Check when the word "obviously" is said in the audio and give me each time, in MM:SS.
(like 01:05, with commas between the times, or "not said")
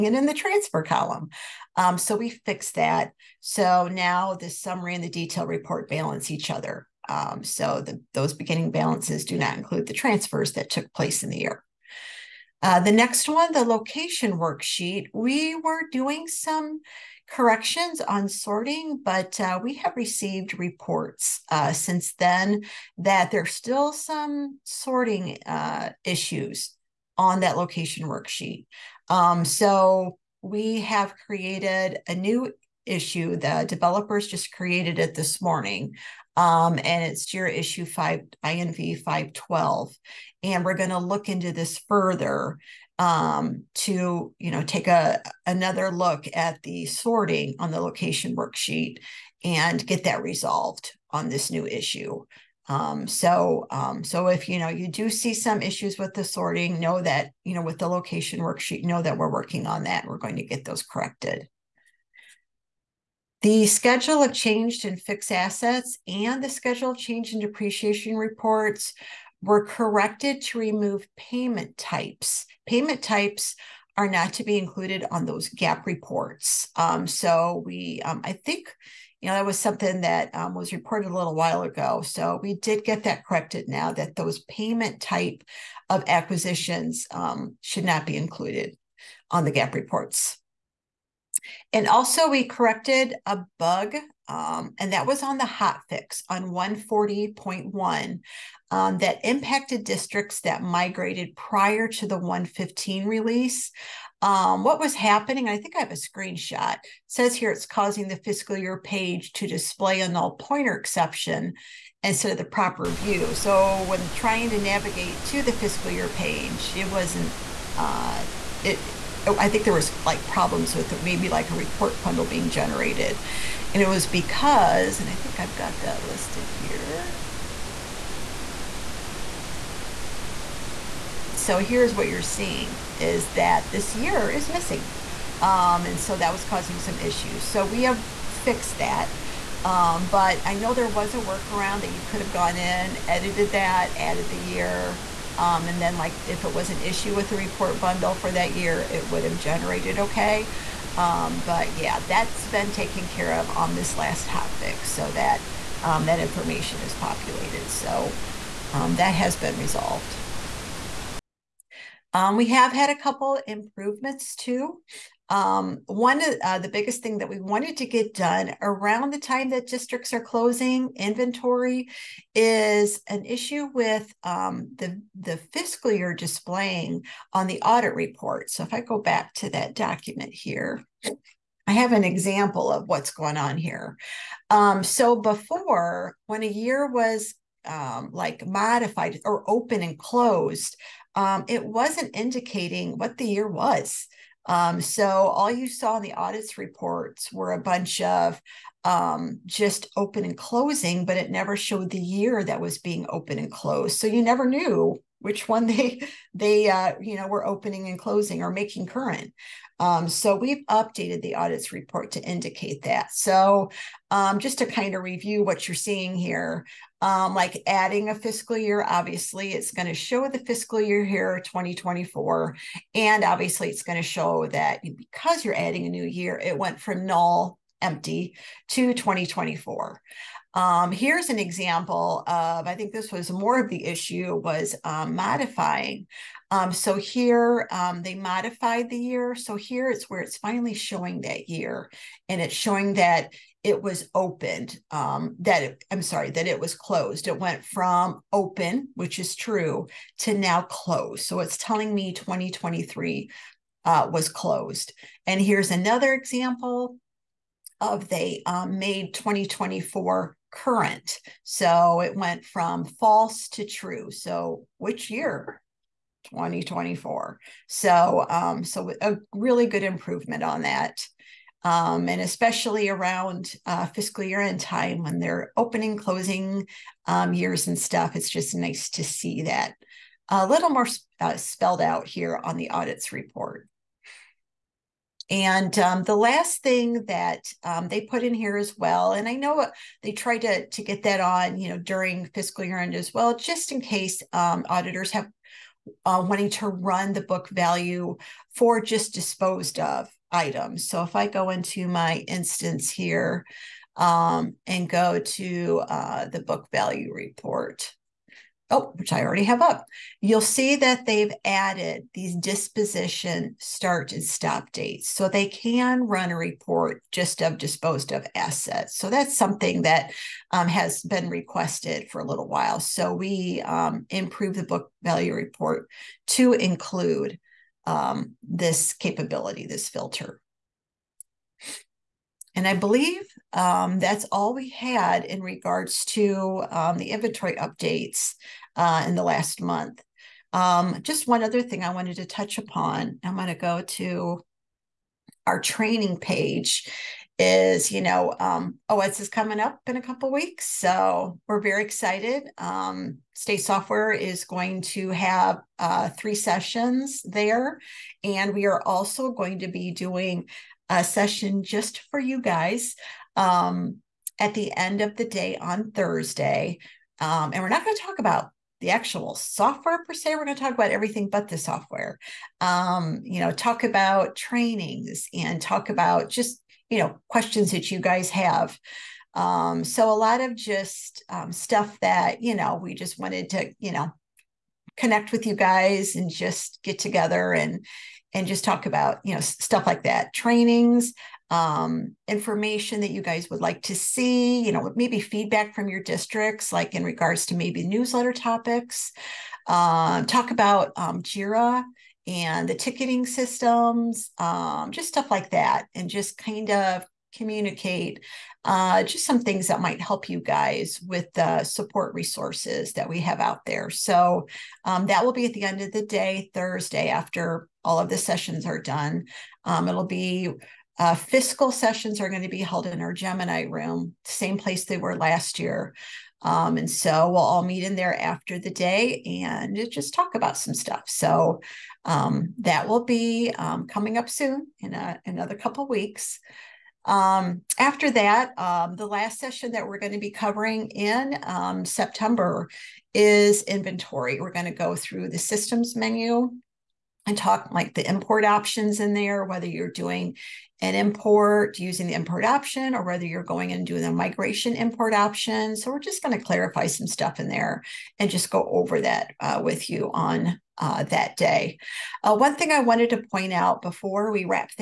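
03:38, 03:43.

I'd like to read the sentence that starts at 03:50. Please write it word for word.
Um, here's an example of, I think this was more of the issue was um, modifying.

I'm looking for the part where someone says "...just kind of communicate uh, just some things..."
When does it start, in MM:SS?
06:46.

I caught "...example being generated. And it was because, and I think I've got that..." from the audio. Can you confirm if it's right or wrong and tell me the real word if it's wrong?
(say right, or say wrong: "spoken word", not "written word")
wrong: "bundle", not "example".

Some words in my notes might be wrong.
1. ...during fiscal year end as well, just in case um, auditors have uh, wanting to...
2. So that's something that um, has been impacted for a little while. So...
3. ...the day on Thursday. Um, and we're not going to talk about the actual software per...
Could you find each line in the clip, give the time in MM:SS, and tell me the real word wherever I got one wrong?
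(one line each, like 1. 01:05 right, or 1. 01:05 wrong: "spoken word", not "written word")
1. 04:51 right
2. 05:18 wrong: "requested", not "impacted"
3. 06:05 right.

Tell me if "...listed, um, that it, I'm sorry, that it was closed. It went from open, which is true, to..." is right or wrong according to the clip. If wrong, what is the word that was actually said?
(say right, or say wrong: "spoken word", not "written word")
wrong: "opened", not "listed".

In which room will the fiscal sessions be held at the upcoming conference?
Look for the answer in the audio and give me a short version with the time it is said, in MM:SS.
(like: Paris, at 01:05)
Gemini room, at 07:03.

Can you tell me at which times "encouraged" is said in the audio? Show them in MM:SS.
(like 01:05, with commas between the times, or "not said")
not said.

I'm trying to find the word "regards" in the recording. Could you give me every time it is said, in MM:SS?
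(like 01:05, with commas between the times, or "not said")
05:35, 06:37.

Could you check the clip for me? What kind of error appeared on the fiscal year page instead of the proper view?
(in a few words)
Null pointer exception.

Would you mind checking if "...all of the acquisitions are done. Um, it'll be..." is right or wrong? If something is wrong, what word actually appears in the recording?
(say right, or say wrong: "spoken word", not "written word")
wrong: "sessions", not "acquisitions".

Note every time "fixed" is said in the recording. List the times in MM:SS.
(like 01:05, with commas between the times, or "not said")
00:02, 01:04, 02:18.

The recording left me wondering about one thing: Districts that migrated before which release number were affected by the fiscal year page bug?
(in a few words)
115.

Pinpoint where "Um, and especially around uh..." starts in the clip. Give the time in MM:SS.
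04:31.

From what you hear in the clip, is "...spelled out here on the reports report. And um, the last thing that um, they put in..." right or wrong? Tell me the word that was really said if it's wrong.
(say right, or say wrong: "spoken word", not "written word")
wrong: "audits", not "reports".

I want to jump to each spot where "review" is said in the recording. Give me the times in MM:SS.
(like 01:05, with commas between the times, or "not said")
03:35.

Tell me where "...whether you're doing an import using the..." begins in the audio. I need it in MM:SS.
07:29.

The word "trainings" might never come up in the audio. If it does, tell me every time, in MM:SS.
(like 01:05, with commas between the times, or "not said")
05:45, 06:14, 06:30.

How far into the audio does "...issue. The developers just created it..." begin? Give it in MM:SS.
00:32.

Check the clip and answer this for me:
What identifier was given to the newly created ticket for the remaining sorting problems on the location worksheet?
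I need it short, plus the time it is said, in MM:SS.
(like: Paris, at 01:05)
INV 512, at 00:38.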